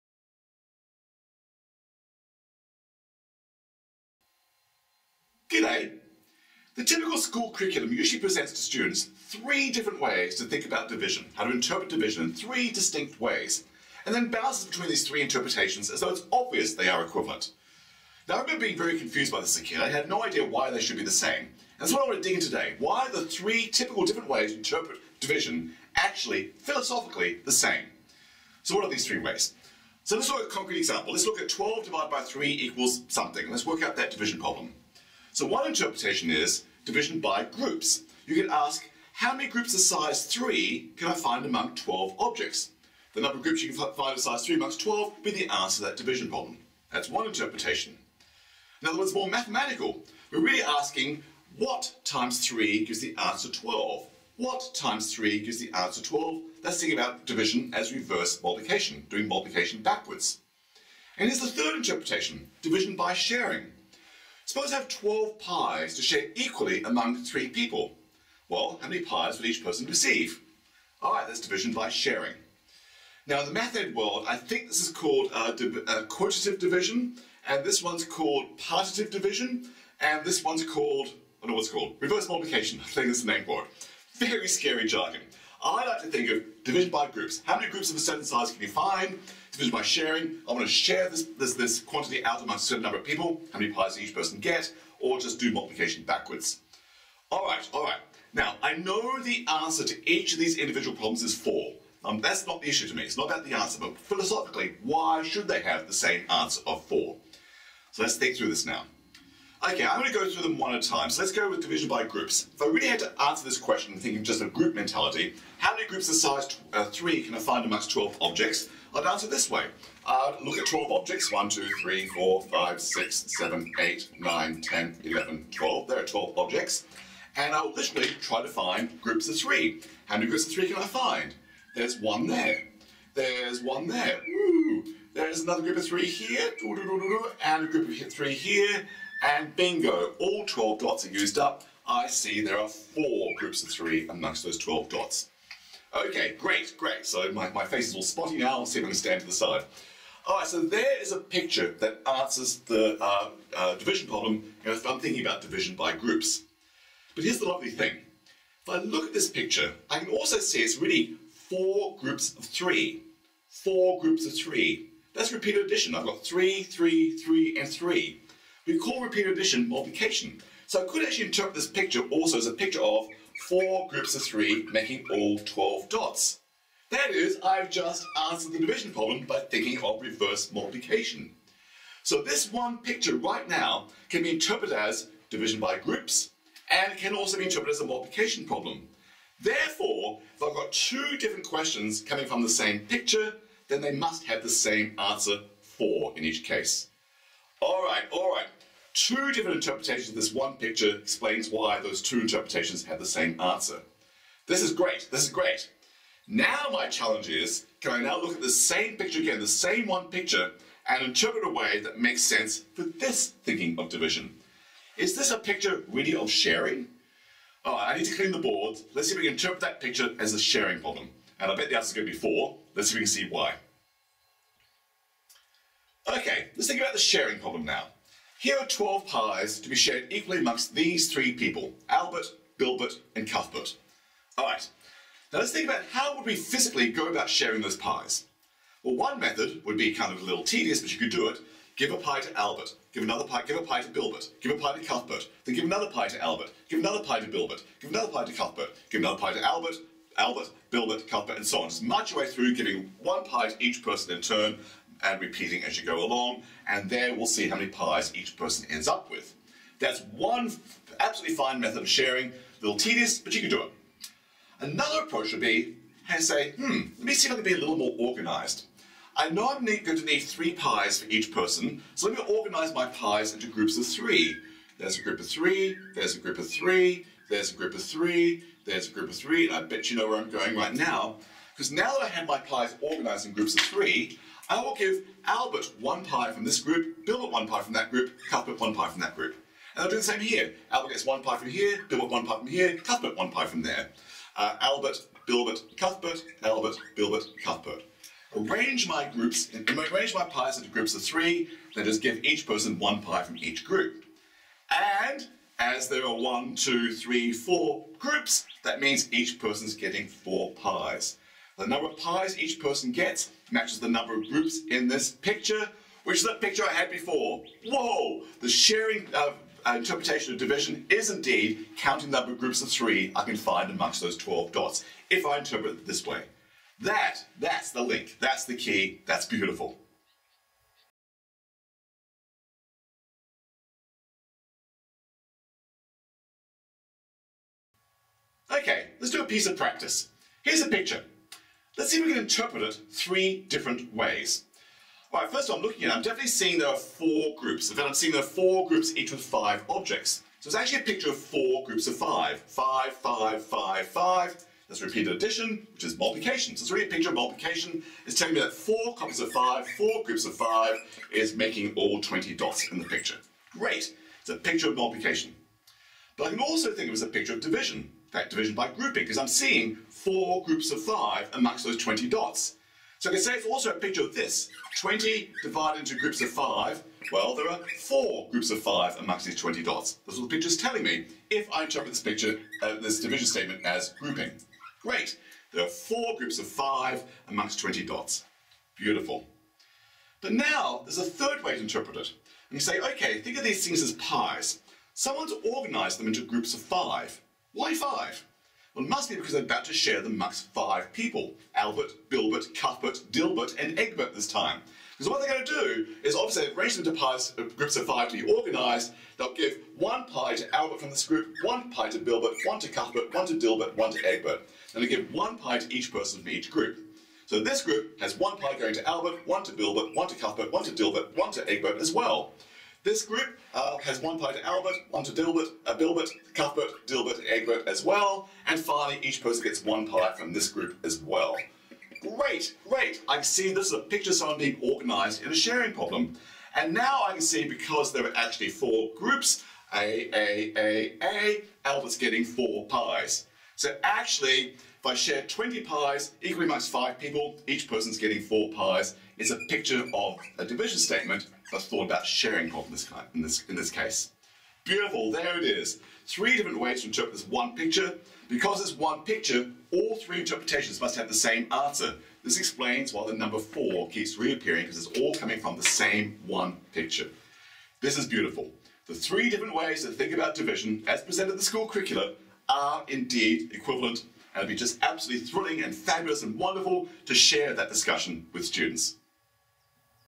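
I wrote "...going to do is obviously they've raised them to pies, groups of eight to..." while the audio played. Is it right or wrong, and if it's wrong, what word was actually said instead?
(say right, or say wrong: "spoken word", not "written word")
wrong: "five", not "eight".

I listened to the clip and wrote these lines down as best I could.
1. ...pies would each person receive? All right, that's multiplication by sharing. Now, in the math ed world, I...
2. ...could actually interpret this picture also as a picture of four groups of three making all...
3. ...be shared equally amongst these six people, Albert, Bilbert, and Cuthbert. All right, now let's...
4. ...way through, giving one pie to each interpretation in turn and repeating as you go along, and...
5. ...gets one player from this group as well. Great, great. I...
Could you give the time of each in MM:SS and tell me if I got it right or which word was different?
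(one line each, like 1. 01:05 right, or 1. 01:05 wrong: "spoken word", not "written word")
1. 01:09 wrong: "division", not "multiplication"
2. 02:50 right
3. 03:49 wrong: "three", not "six"
4. 04:12 wrong: "person", not "interpretation"
5. 07:09 right.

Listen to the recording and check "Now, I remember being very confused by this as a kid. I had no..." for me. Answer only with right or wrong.
right.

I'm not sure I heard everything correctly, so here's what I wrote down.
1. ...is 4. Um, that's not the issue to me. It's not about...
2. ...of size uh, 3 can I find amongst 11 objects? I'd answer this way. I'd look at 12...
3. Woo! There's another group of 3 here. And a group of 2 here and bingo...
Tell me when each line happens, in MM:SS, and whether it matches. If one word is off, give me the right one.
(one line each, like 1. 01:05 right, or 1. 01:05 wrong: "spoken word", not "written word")
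1. 01:41 right
2. 01:56 wrong: "12", not "11"
3. 02:14 wrong: "3", not "2".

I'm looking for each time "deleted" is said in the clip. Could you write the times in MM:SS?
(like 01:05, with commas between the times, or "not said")
not said.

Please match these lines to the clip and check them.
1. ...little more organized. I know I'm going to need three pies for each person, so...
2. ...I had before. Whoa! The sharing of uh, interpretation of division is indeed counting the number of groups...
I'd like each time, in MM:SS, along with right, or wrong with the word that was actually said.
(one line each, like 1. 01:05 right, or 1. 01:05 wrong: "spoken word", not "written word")
1. 04:27 right
2. 05:16 right.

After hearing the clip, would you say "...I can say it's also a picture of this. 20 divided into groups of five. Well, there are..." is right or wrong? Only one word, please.
right.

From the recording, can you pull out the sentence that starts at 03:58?
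Well, one method would be kind of a little tedious, but you could do it.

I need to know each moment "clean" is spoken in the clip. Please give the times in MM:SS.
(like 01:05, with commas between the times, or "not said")
03:38.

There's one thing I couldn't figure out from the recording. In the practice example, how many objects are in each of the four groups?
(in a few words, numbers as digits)
5.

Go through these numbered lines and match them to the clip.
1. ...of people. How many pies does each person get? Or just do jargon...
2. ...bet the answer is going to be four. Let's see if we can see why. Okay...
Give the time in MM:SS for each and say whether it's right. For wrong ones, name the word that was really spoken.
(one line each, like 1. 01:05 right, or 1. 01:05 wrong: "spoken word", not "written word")
1. 01:32 wrong: "multiplication", not "jargon"
2. 03:41 right.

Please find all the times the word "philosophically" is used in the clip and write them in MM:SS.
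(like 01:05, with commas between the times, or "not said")
00:26, 01:43.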